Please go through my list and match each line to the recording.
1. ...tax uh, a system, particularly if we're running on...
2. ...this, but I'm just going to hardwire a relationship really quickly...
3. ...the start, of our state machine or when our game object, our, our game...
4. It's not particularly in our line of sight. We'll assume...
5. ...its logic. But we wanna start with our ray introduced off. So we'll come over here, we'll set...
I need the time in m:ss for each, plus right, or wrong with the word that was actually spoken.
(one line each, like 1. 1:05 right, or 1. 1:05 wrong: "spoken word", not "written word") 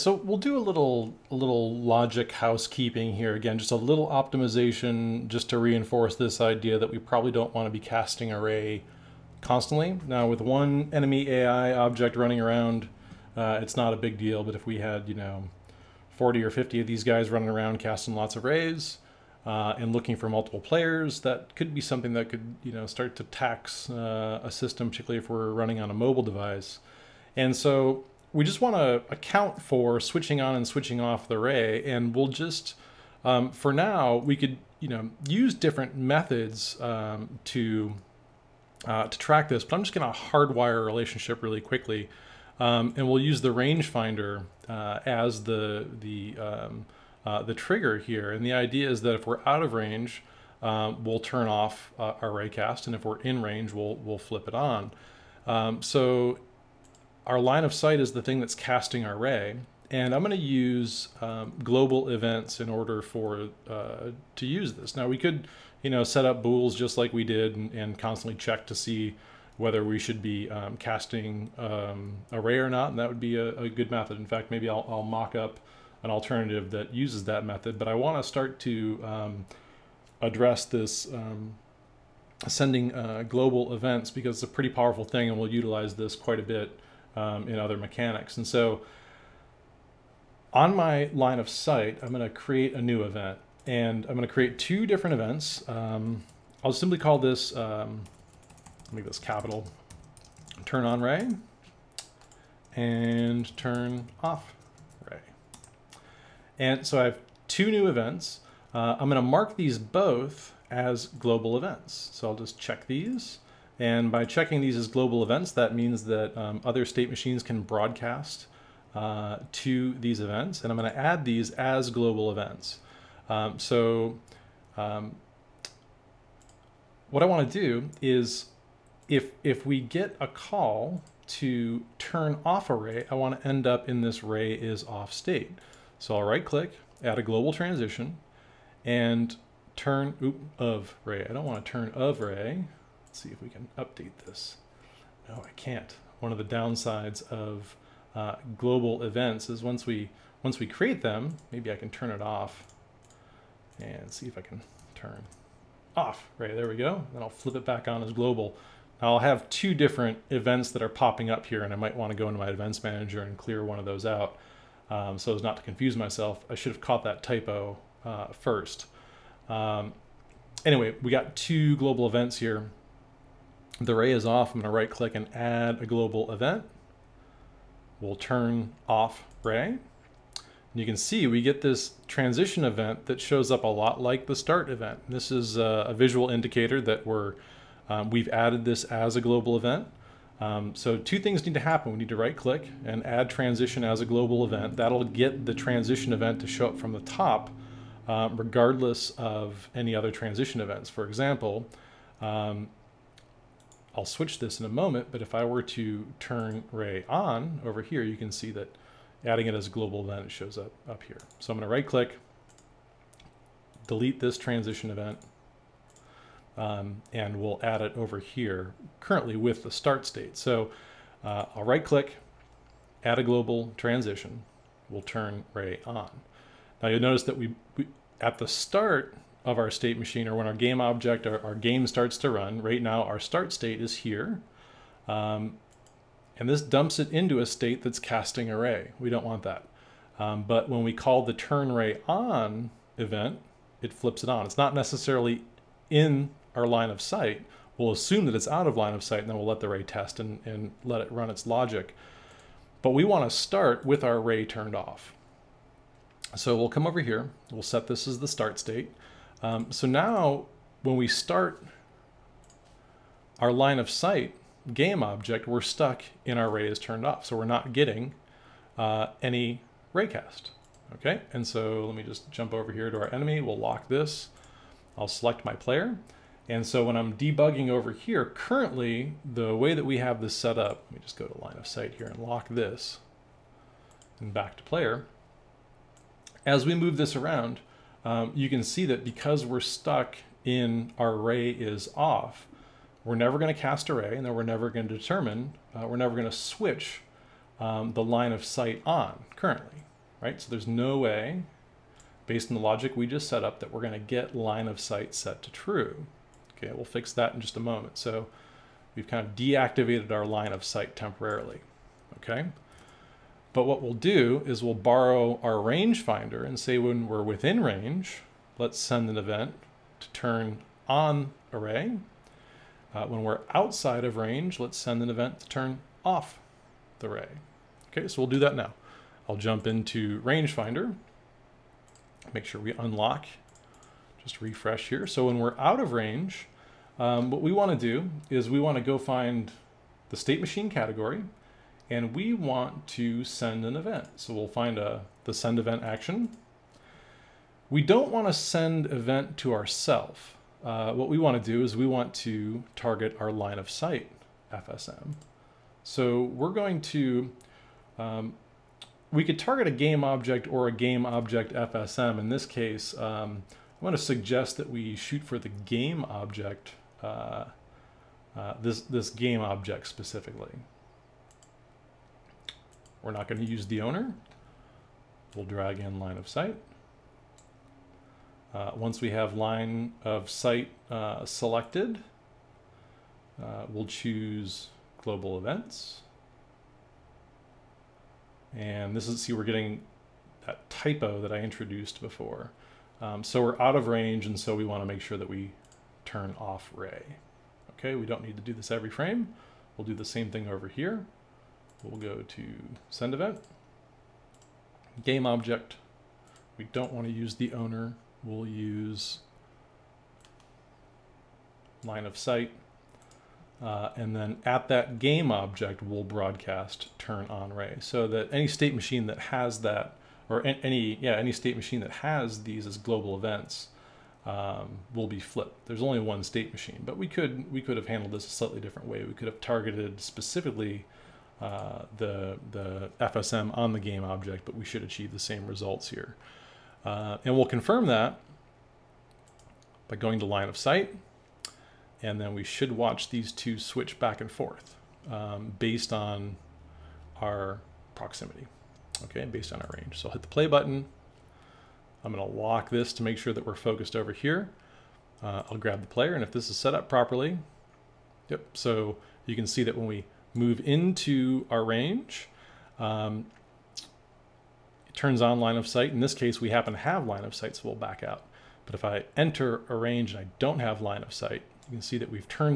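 1. 0:23 right
2. 0:39 right
3. 3:48 right
4. 4:04 wrong: "necessarily", not "particularly"
5. 4:11 wrong: "turned", not "introduced".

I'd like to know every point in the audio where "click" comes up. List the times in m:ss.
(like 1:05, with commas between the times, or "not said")
2:16, 2:54, 3:12, 3:31, 3:41.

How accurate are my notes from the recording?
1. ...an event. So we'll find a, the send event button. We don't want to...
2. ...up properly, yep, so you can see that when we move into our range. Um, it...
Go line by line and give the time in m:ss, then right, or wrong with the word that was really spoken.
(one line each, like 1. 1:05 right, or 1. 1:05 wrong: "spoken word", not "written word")
1. 5:43 wrong: "action", not "button"
2. 7:36 right.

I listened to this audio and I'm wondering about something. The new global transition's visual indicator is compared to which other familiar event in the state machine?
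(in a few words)
the start event.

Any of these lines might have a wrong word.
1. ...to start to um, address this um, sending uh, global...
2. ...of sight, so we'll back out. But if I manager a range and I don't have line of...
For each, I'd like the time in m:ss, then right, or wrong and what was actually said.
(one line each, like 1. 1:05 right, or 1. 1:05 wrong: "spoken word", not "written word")
1. 1:18 right
2. 7:47 wrong: "enter", not "manager".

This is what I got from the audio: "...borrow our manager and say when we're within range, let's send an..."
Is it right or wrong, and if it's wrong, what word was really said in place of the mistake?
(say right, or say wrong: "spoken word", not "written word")
wrong: "rangefinder", not "manager".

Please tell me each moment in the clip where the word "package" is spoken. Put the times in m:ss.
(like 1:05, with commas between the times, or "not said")
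not said.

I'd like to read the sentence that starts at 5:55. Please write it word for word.
So we're going to, um, we could target a game object or a game object FSM.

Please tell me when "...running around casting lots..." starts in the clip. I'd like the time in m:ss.
0:17.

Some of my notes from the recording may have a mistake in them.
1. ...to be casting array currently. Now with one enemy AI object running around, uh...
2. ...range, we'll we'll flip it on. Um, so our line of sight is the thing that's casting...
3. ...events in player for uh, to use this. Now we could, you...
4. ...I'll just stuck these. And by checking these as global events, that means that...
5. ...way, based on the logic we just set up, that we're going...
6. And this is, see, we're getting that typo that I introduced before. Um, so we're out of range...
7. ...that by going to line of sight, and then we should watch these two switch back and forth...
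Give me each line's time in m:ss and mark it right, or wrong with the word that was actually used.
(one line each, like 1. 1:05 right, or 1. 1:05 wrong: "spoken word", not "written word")
1. 0:07 wrong: "constantly", not "currently"
2. 0:53 right
3. 1:02 wrong: "order", not "player"
4. 1:52 wrong: "check", not "stuck"
5. 5:00 right
6. 6:28 right
7. 7:17 right.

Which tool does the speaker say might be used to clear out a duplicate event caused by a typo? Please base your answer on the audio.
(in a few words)
events manager.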